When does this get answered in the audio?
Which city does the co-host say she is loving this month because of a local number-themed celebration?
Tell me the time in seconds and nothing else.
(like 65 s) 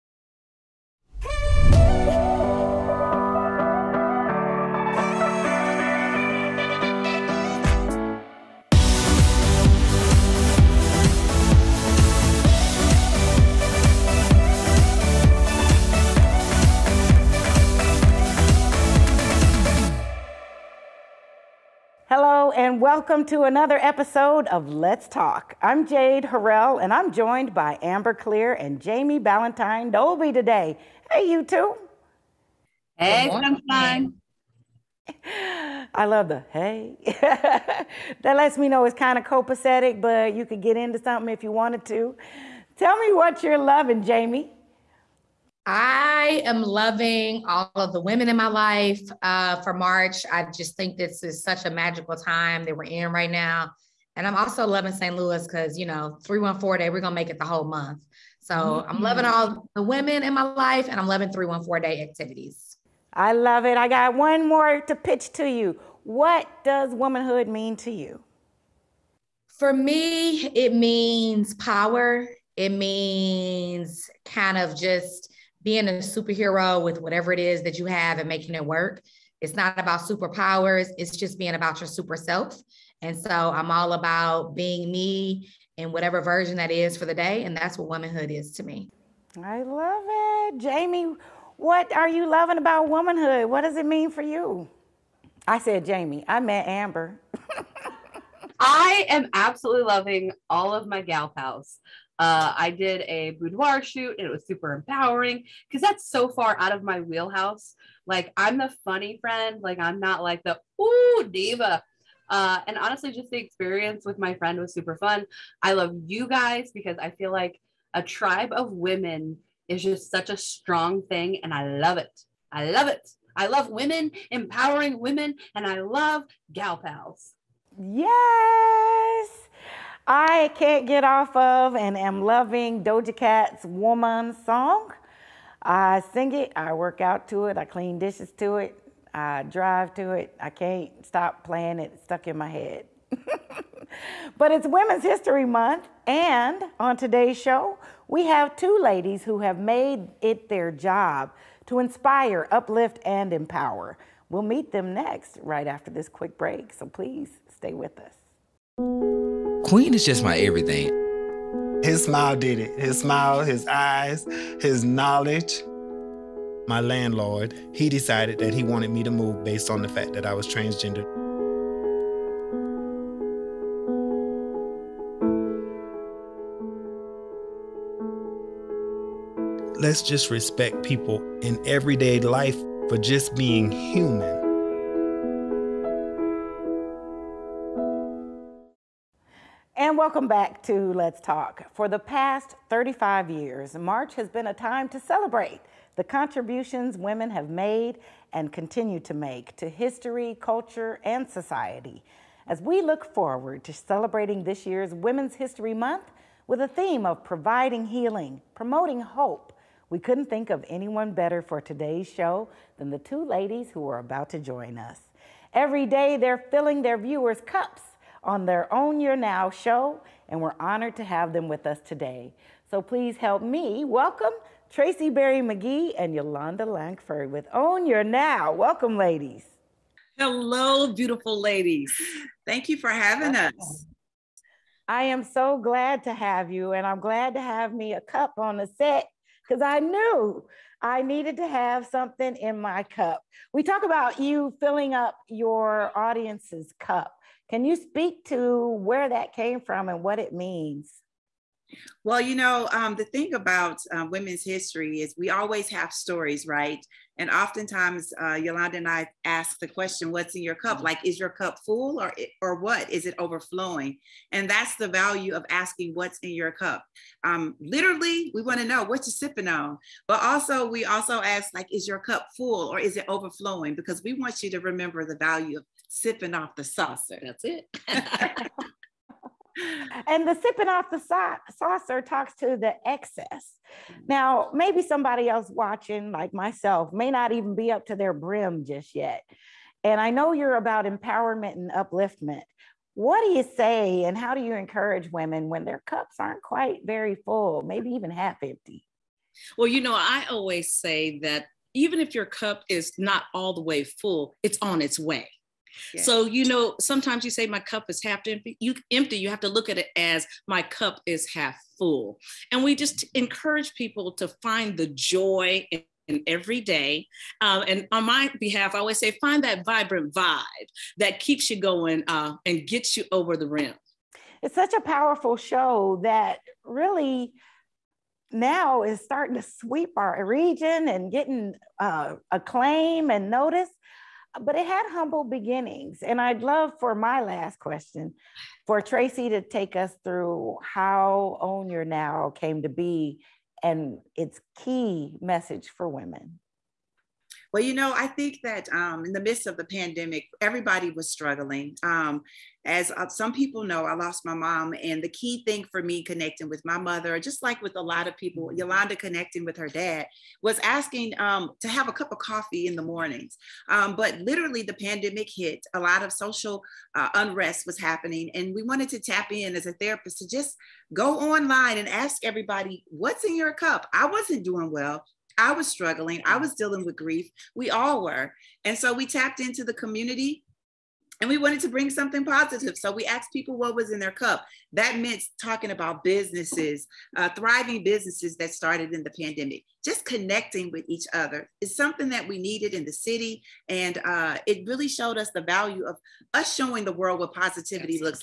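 54 s.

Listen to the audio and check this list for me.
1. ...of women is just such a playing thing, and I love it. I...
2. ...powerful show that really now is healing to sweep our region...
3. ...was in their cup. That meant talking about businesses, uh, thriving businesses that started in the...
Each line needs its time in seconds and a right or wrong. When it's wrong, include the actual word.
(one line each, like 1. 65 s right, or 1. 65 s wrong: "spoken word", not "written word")
1. 118 s wrong: "strong", not "playing"
2. 324 s wrong: "starting", not "healing"
3. 383 s right.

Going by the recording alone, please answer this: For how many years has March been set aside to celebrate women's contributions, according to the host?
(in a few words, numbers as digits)
35.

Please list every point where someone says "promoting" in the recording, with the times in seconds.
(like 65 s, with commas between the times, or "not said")
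208 s.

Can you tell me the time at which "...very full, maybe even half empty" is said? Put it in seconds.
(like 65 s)
296 s.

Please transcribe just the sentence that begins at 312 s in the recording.
And we just encourage people to find the joy in, in every day.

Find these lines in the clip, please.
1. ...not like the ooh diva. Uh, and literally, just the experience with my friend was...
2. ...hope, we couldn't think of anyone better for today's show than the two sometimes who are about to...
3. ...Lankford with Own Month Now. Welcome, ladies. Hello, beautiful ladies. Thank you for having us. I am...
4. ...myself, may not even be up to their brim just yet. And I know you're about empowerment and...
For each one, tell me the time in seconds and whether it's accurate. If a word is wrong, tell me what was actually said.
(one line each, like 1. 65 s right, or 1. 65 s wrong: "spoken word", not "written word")
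1. 109 s wrong: "honestly", not "literally"
2. 209 s wrong: "ladies", not "sometimes"
3. 226 s wrong: "Your", not "Month"
4. 286 s right.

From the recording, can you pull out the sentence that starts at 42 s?
Tell me what you're loving, Jamie.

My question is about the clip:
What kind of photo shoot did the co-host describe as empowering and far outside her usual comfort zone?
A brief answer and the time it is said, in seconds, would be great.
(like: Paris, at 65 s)
boudoir shoot, at 103 s.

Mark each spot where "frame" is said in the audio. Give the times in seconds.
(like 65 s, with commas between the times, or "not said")
not said.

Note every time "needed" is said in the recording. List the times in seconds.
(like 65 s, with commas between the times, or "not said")
241 s, 392 s.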